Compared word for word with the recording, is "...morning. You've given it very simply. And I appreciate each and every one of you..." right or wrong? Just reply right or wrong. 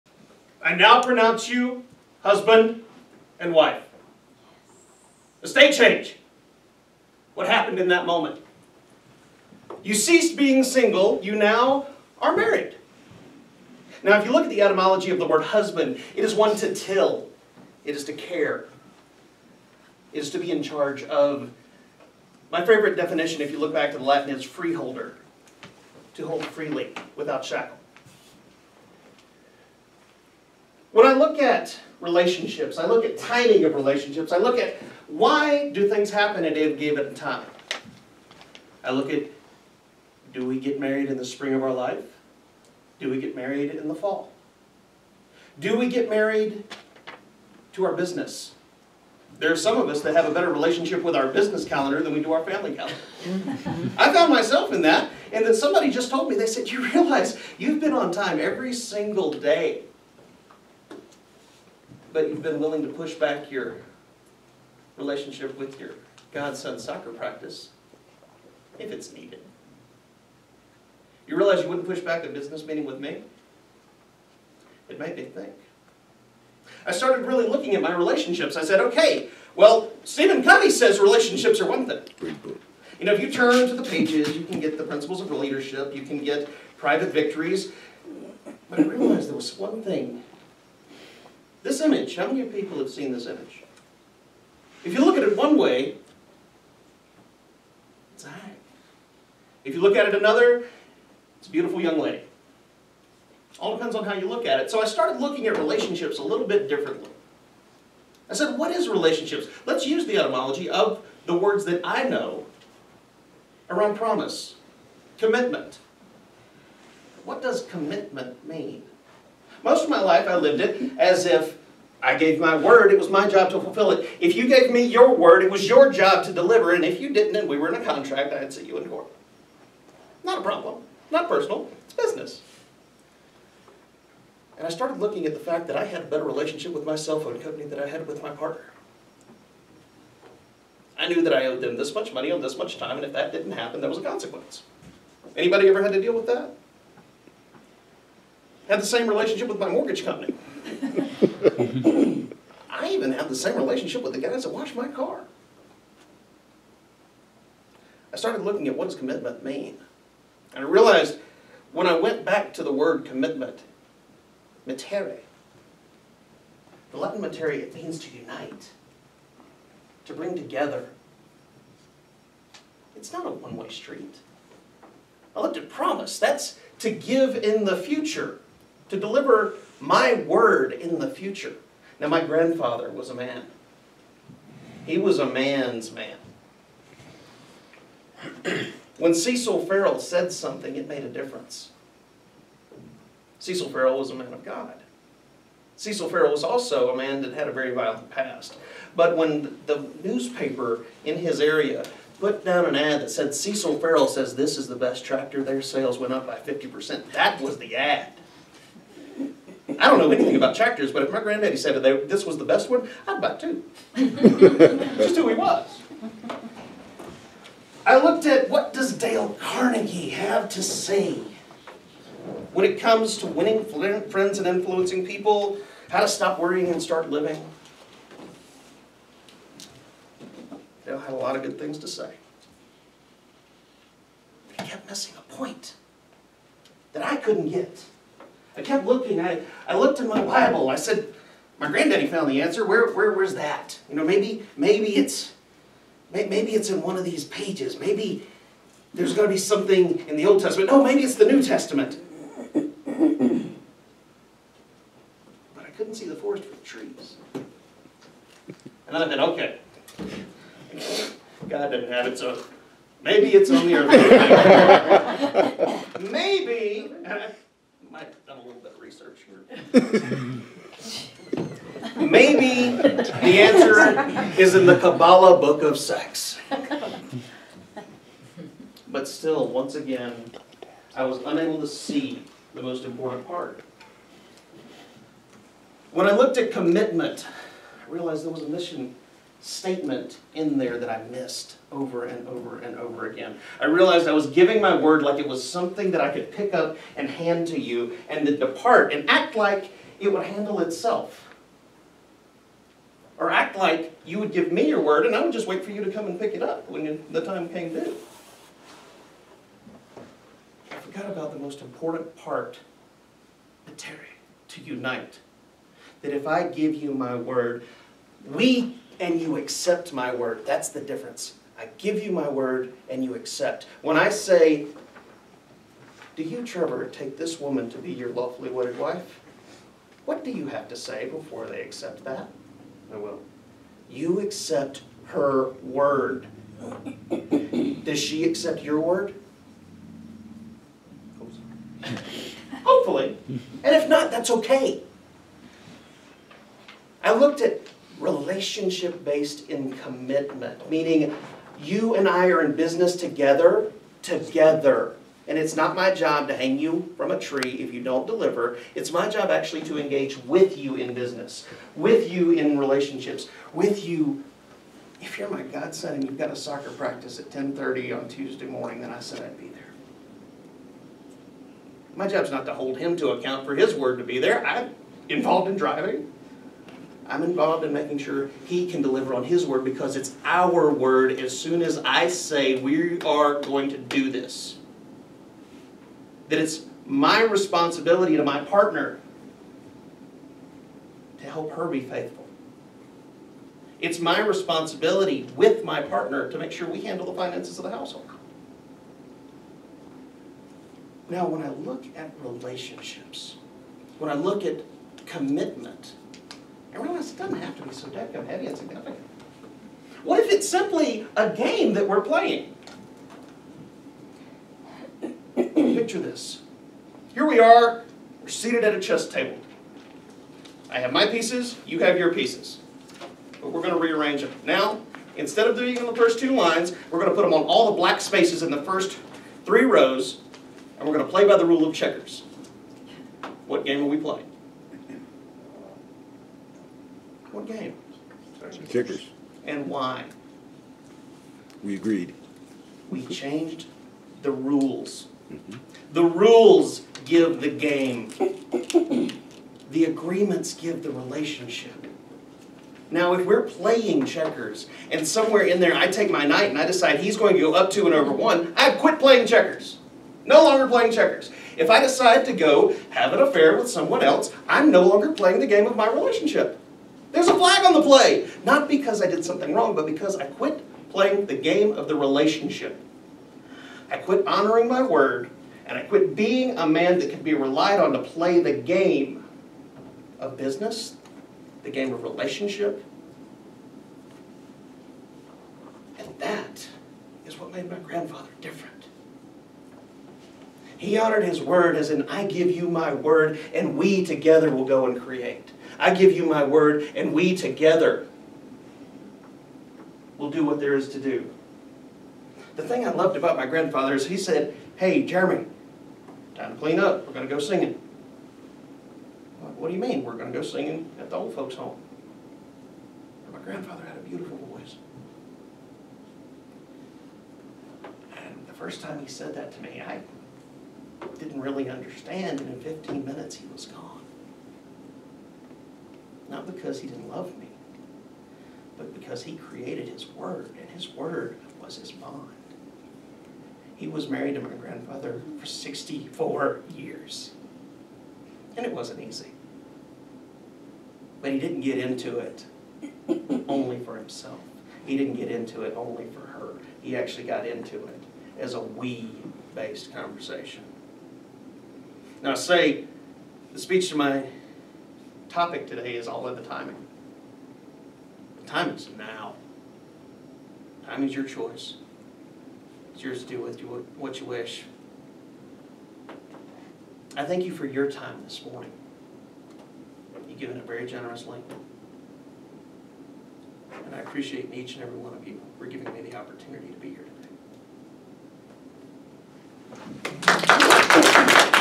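wrong.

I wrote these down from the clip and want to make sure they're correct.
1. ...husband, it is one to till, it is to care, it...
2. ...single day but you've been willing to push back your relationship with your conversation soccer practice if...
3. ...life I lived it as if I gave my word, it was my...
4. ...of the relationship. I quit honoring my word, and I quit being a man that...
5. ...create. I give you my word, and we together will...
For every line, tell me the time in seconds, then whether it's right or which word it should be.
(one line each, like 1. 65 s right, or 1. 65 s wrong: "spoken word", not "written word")
1. 15 s right
2. 58 s wrong: "godson", not "conversation"
3. 120 s right
4. 471 s right
5. 494 s right.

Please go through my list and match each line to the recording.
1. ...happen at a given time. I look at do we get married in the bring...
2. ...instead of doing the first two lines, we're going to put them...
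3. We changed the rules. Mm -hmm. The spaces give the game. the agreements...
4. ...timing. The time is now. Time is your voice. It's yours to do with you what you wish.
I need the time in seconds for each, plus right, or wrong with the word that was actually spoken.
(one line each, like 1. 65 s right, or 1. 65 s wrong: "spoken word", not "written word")
1. 36 s wrong: "spring", not "bring"
2. 425 s right
3. 442 s wrong: "rules", not "spaces"
4. 556 s wrong: "choice", not "voice".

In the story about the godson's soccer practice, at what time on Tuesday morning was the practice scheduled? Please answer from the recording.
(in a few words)
10:30.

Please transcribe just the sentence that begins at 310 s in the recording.
I forgot about the most important part, the Terry, to unite.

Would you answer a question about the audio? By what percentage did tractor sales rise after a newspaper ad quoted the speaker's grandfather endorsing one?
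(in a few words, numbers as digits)
50%.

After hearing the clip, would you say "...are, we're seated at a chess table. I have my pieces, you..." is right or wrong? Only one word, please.
right.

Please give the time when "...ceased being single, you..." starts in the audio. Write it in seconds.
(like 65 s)
9 s.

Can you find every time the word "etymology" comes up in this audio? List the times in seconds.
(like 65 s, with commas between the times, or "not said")
14 s, 110 s.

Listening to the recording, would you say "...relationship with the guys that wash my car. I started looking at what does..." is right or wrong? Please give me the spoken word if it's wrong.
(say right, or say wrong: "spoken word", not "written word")
right.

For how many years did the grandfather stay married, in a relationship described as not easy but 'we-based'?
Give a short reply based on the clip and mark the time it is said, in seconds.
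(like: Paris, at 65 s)
64, at 535 s.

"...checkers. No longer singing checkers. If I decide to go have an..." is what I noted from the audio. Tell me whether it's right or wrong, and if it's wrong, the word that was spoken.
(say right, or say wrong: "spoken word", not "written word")
wrong: "playing", not "singing".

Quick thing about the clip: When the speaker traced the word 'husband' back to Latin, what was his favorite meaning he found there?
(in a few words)
freeholder.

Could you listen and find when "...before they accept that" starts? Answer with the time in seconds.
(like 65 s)
331 s.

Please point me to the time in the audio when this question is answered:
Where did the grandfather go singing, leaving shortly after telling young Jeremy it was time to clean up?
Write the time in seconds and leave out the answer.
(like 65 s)
511 s.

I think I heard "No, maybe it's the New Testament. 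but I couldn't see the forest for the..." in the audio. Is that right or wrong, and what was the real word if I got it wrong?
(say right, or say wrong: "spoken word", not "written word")
right.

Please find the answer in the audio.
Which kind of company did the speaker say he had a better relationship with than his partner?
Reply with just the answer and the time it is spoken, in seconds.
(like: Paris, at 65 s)
cell phone company, at 136 s.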